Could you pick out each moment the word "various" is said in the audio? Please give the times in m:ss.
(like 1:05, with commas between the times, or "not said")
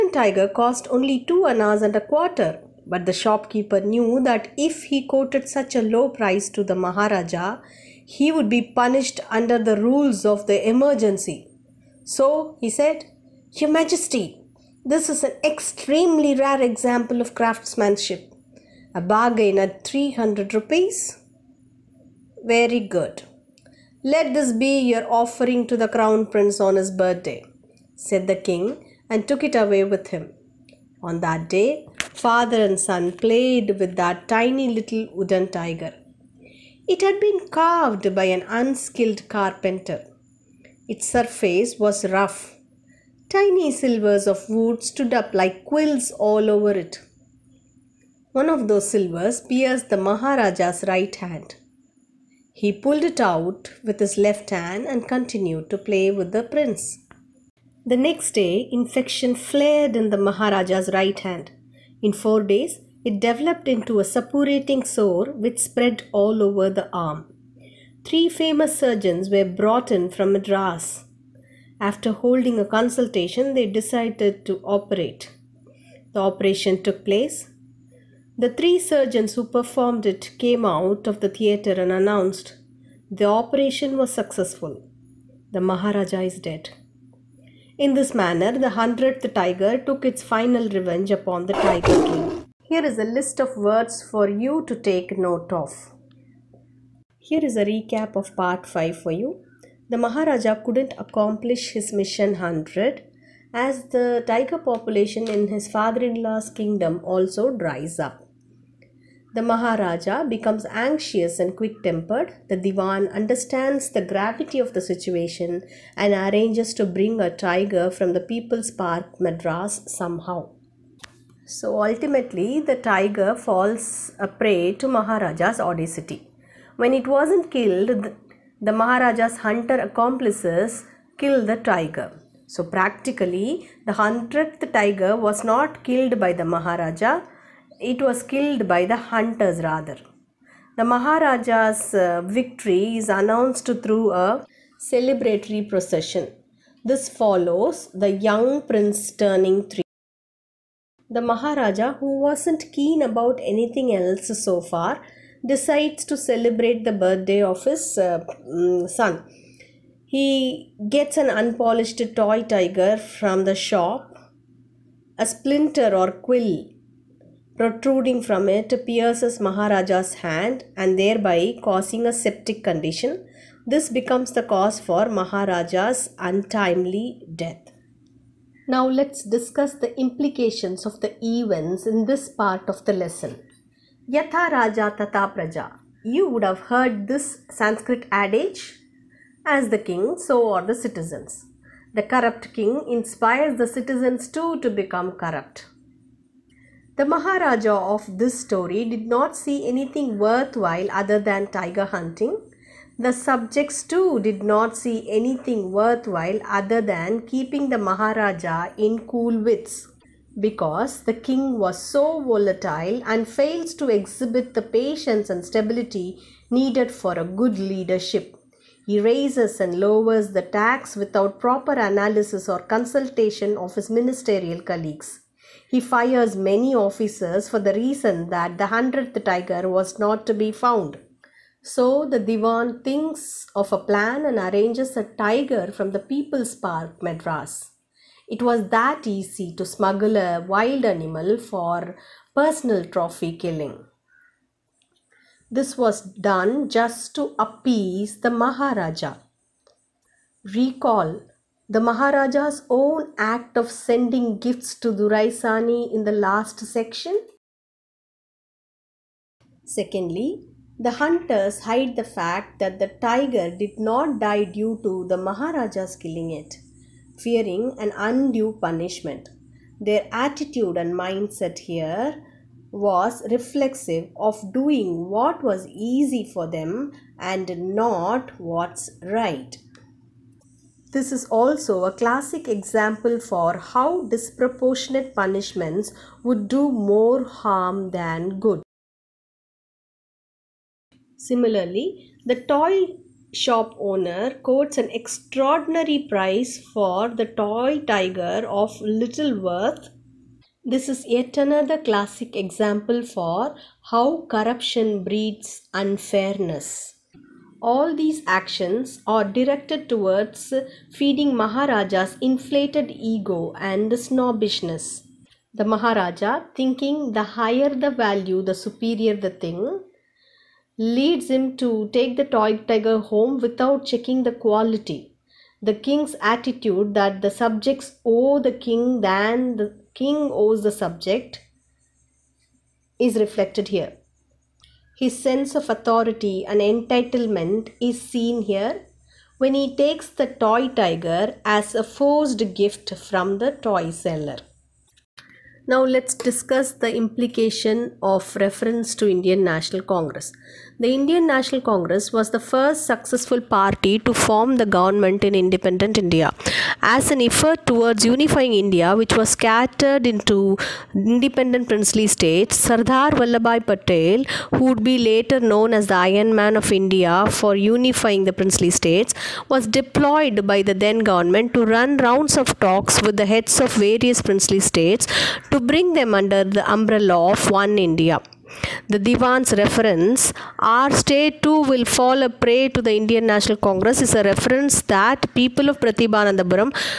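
6:13.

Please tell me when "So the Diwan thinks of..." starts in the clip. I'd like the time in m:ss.
3:51.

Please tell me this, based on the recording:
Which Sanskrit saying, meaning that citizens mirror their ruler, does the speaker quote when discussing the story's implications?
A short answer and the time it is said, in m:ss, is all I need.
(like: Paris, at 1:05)
Yatha Raja Tata Praja, at 3:04.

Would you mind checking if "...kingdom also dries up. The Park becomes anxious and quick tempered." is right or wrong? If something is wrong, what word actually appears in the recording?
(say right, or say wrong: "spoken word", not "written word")
wrong: "Maharaja", not "Park".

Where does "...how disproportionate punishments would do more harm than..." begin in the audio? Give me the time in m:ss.
4:43.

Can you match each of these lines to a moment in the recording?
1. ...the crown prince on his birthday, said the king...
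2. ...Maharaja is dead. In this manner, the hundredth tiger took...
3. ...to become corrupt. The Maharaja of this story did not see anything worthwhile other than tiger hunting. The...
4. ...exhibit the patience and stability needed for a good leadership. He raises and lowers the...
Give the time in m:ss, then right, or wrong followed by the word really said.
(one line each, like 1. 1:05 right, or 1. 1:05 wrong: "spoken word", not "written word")
1. 0:25 right
2. 1:25 right
3. 3:14 right
4. 3:33 right.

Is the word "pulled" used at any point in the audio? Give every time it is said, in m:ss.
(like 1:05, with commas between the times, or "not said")
0:52.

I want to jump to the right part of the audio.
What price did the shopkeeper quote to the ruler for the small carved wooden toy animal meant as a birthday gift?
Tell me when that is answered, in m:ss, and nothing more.
0:19.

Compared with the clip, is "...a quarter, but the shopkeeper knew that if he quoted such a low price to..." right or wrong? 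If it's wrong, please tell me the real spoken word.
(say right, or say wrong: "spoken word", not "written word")
right.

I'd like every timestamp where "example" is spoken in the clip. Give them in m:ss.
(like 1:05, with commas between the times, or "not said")
0:16, 4:42, 5:02.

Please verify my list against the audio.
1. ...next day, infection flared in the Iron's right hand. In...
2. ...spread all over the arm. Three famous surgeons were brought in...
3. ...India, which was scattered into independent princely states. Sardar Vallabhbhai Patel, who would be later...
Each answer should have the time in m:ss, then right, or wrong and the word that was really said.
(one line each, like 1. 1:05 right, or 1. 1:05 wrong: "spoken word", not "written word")
1. 0:57 wrong: "Maharaja", not "Iron"
2. 1:05 right
3. 5:58 right.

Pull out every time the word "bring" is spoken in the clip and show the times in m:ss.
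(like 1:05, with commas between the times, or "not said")
1:56, 6:15.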